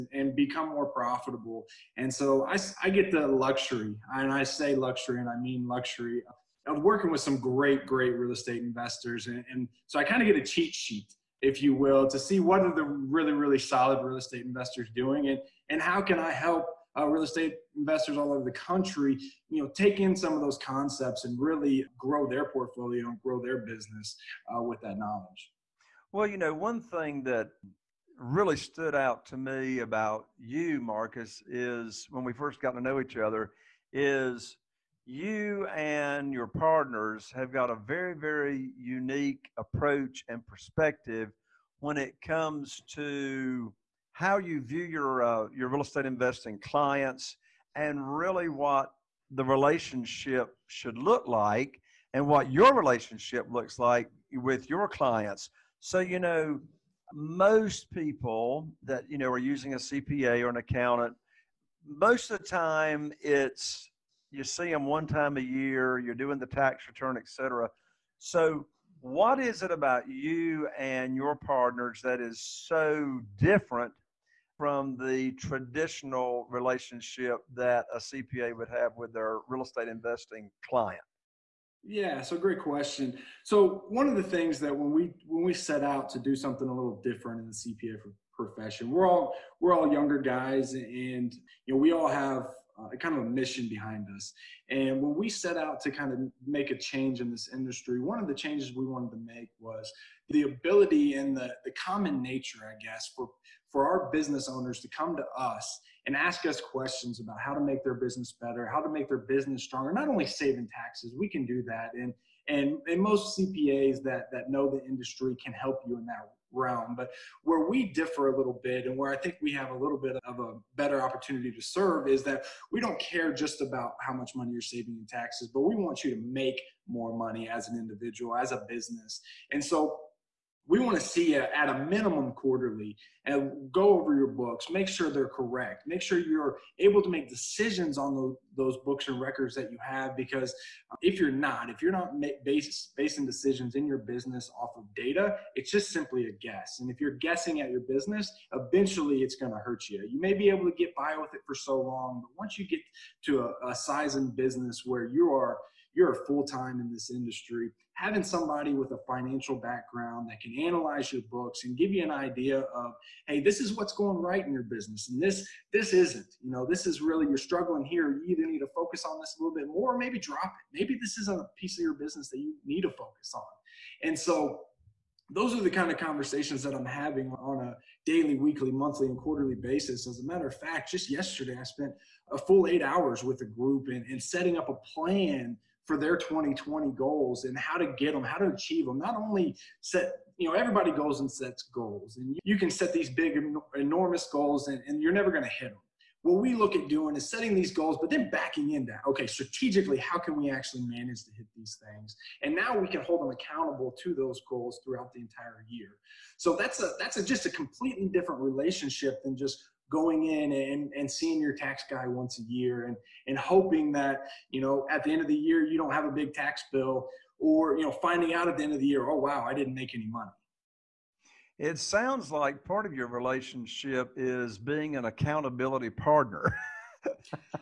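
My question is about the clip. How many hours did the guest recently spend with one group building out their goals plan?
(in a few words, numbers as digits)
8.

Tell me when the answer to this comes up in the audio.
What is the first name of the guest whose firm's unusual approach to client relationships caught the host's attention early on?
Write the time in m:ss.
0:30.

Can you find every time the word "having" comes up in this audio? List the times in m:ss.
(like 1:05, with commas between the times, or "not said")
2:37, 2:56.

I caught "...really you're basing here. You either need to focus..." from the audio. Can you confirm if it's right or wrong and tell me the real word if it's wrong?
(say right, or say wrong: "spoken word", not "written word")
wrong: "struggling", not "basing".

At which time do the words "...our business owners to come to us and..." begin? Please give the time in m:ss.
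1:43.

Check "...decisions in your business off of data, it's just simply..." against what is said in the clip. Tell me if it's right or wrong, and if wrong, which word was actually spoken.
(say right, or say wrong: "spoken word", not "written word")
right.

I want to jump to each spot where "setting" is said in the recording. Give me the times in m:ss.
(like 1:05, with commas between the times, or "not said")
3:04, 3:17.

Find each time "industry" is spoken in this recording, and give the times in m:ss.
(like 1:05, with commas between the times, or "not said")
1:37, 1:54, 2:37.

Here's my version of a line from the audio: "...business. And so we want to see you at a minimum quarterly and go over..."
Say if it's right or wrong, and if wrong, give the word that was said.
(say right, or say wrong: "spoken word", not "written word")
right.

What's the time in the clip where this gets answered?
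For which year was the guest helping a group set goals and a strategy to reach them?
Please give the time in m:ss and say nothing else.
3:06.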